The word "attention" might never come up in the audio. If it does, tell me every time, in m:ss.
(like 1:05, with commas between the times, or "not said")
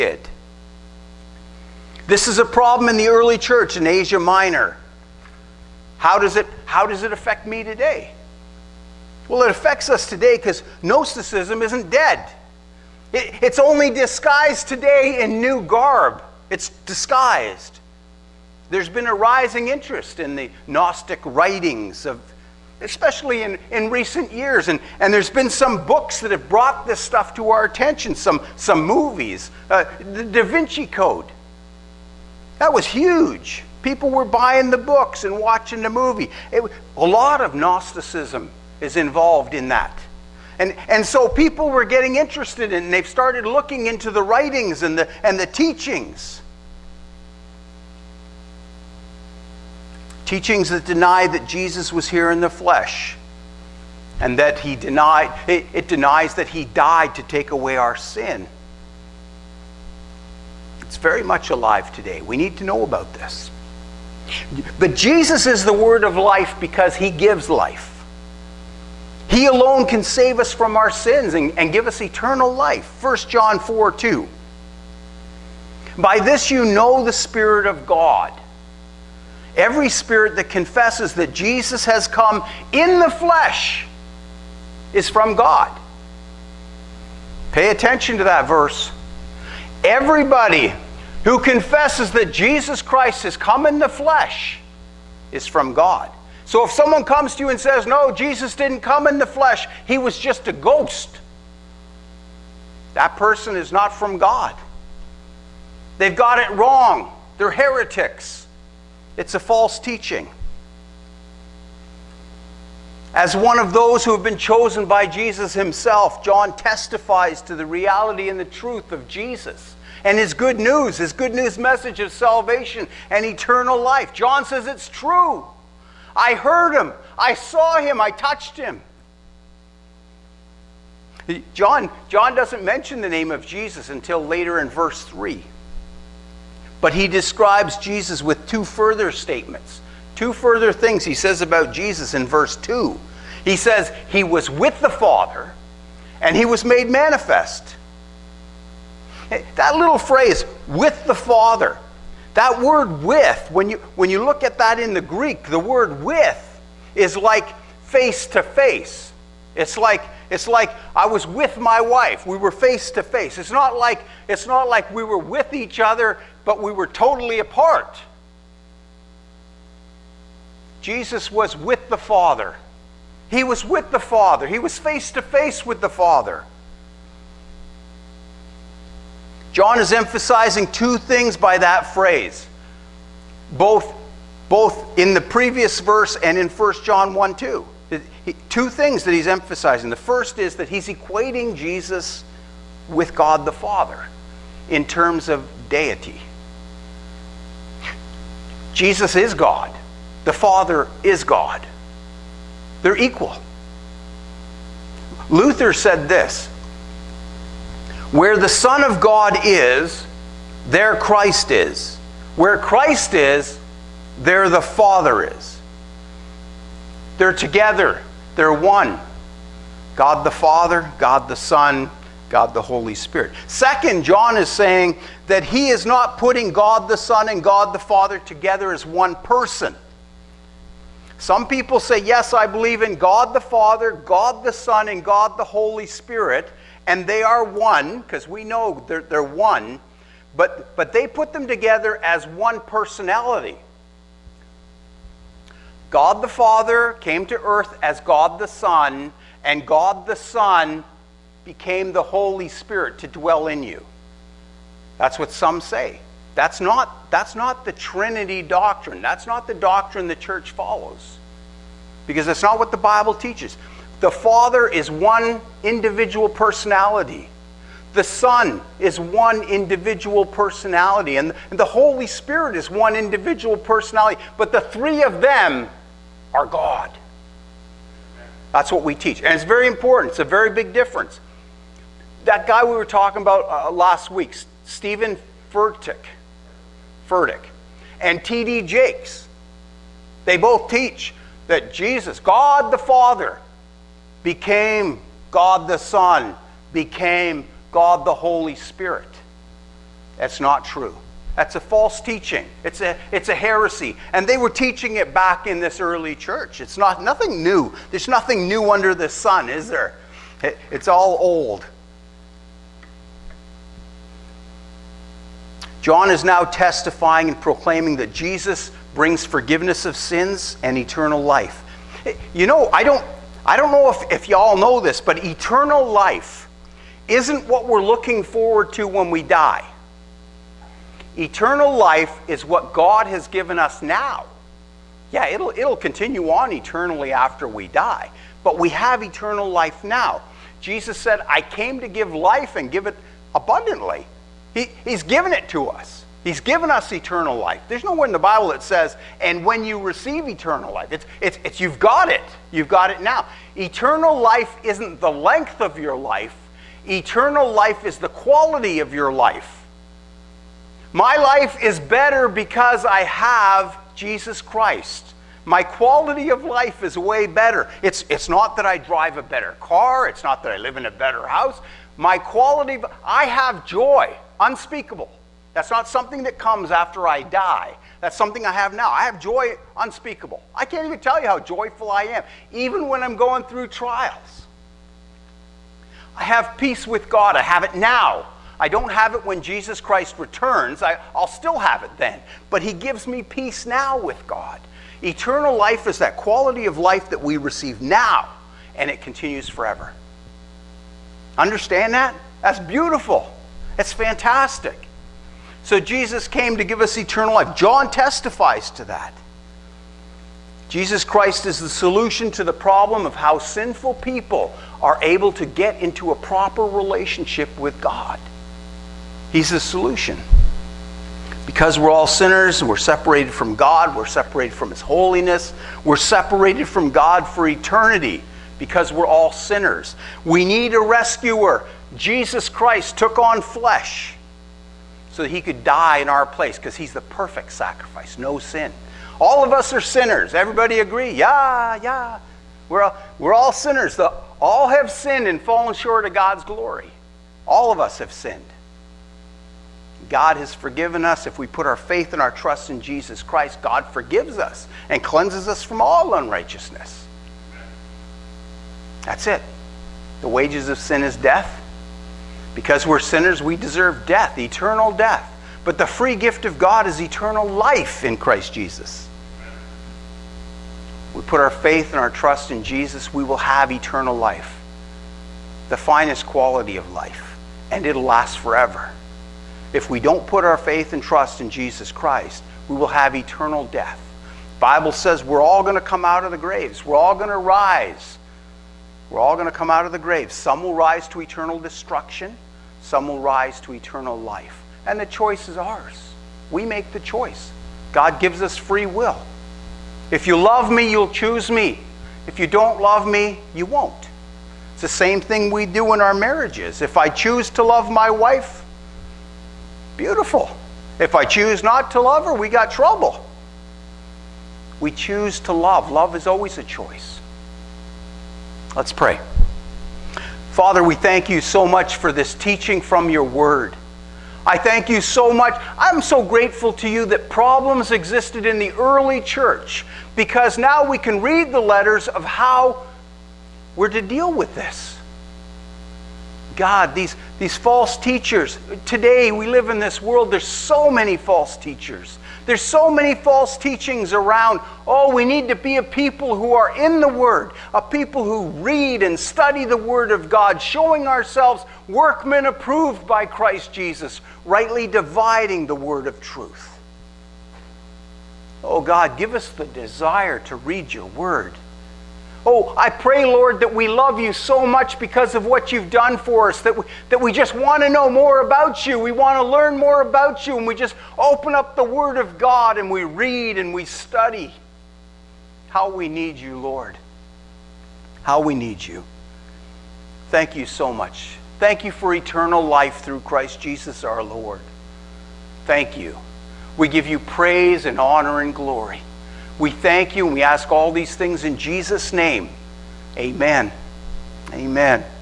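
0:27, 1:27.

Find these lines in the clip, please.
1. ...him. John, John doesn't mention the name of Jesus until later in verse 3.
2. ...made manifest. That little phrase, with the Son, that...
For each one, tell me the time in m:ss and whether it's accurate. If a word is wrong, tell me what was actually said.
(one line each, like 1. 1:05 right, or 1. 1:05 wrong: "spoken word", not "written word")
1. 2:08 right
2. 2:26 wrong: "Father", not "Son".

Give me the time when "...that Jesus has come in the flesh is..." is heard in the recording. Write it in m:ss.
1:21.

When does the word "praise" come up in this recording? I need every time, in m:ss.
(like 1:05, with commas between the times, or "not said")
9:47.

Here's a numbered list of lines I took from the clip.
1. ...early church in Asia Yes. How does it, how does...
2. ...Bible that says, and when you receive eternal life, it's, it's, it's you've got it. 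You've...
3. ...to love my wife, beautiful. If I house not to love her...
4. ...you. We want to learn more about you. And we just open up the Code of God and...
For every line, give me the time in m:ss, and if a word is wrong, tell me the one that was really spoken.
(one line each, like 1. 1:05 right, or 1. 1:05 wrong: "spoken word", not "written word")
1. 0:03 wrong: "Minor", not "Yes"
2. 5:48 right
3. 8:27 wrong: "choose", not "house"
4. 9:28 wrong: "Word", not "Code".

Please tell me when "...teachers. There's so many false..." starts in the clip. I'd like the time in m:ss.
9:01.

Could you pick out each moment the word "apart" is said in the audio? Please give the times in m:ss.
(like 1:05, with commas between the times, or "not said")
2:47.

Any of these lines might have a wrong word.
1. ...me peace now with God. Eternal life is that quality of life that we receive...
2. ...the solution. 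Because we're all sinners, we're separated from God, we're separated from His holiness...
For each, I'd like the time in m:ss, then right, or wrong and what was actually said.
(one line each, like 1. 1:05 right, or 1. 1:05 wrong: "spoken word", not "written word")
1. 6:33 right
2. 6:59 right.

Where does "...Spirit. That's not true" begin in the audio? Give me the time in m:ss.
4:58.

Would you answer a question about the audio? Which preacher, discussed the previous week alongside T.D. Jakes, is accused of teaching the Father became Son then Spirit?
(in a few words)
Steven Furtick.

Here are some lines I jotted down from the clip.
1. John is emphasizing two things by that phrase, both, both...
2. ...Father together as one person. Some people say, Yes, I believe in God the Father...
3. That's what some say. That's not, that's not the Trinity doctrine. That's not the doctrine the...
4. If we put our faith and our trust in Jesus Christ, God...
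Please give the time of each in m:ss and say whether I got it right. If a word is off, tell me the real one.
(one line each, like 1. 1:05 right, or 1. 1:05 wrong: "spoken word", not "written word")
1. 2:59 right
2. 3:47 right
3. 4:14 right
4. 7:31 right.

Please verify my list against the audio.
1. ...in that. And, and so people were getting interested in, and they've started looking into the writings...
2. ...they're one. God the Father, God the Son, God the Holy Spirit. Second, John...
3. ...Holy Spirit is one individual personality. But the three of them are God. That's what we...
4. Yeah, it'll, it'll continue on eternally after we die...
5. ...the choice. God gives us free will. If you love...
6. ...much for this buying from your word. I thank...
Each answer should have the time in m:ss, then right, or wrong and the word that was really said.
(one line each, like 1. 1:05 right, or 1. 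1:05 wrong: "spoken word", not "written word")
1. 0:39 right
2. 3:38 right
3. 4:31 right
4. 5:35 right
5. 8:16 right
6. 8:41 wrong: "teaching", not "buying".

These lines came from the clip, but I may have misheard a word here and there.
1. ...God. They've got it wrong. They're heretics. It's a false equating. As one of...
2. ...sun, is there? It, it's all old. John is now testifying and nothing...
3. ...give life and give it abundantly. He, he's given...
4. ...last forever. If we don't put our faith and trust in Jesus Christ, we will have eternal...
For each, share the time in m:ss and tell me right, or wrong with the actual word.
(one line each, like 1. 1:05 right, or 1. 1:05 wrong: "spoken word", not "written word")
1. 1:44 wrong: "teaching", not "equating"
2. 5:09 wrong: "proclaiming", not "nothing"
3. 5:41 right
4. 7:58 right.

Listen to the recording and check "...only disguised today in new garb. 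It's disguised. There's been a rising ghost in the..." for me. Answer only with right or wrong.
wrong.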